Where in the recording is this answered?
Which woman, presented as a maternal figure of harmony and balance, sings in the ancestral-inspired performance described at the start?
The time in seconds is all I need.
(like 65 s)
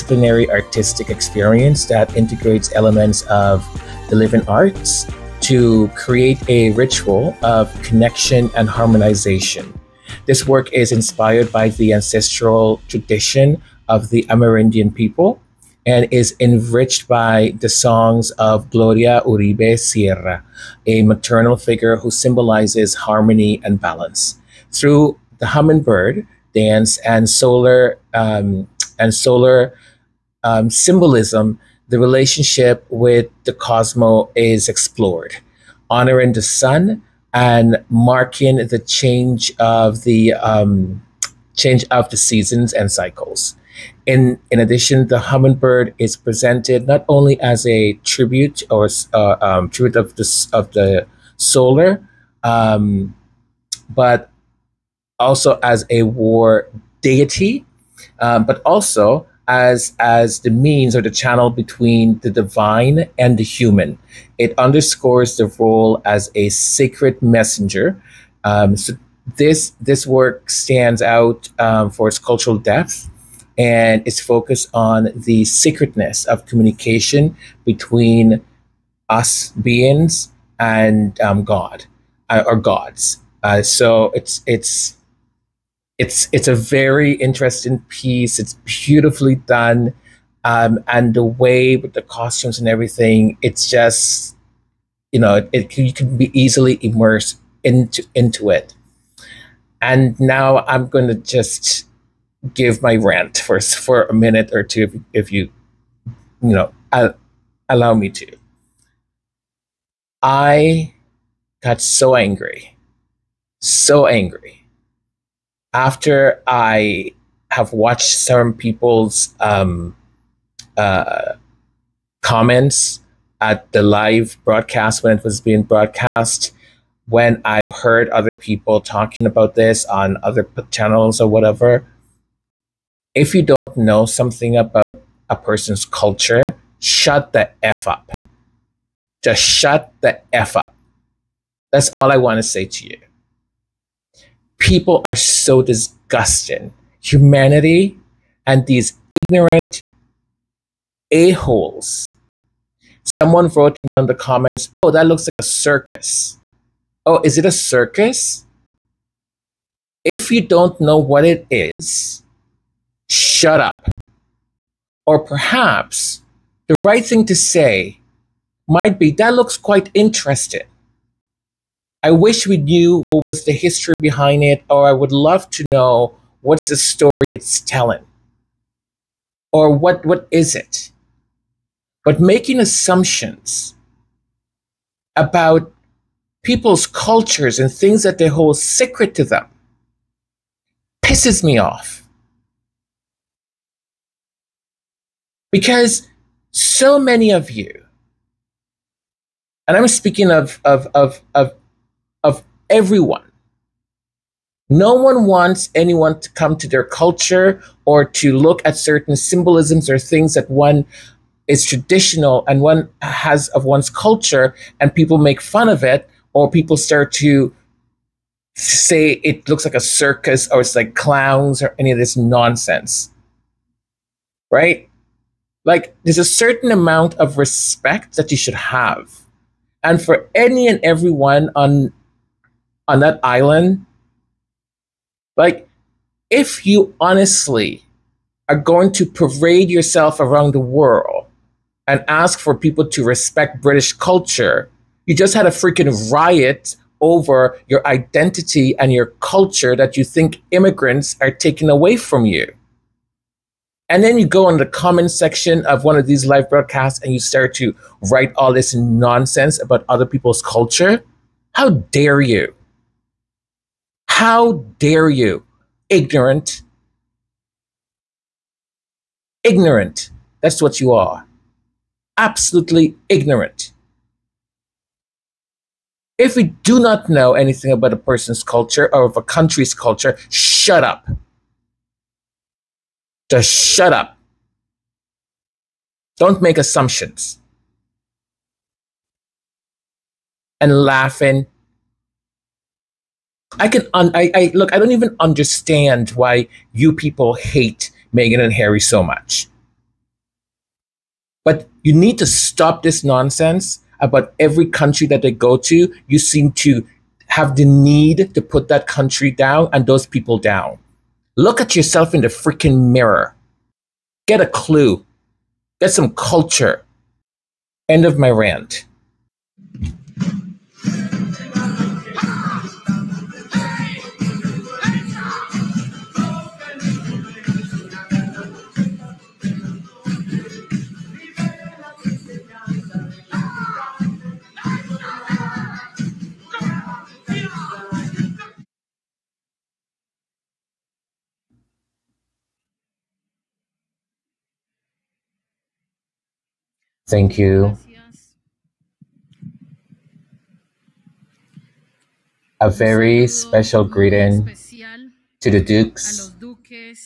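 18 s.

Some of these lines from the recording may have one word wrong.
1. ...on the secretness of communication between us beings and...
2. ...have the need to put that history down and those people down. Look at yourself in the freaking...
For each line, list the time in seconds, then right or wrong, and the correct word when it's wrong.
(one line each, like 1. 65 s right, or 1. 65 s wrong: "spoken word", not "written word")
1. 74 s right
2. 307 s wrong: "country", not "history".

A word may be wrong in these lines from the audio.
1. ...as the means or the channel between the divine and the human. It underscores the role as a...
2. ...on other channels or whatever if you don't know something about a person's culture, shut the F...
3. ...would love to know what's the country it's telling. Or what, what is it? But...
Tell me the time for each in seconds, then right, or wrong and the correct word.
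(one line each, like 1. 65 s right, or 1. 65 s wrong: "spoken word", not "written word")
1. 59 s right
2. 129 s right
3. 174 s wrong: "story", not "country".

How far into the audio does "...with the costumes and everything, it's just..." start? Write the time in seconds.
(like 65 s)
91 s.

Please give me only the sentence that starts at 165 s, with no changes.
Or perhaps the right thing to say might be that looks quite interesting.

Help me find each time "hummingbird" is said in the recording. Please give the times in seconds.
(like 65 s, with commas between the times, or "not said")
25 s, 45 s.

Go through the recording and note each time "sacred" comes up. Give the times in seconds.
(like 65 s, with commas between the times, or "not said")
66 s, 188 s.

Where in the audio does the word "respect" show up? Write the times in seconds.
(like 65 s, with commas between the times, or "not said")
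227 s, 243 s.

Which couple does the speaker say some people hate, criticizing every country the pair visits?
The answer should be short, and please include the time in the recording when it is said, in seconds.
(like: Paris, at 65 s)
Meghan and Harry, at 298 s.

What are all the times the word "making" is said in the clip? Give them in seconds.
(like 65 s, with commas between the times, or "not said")
182 s.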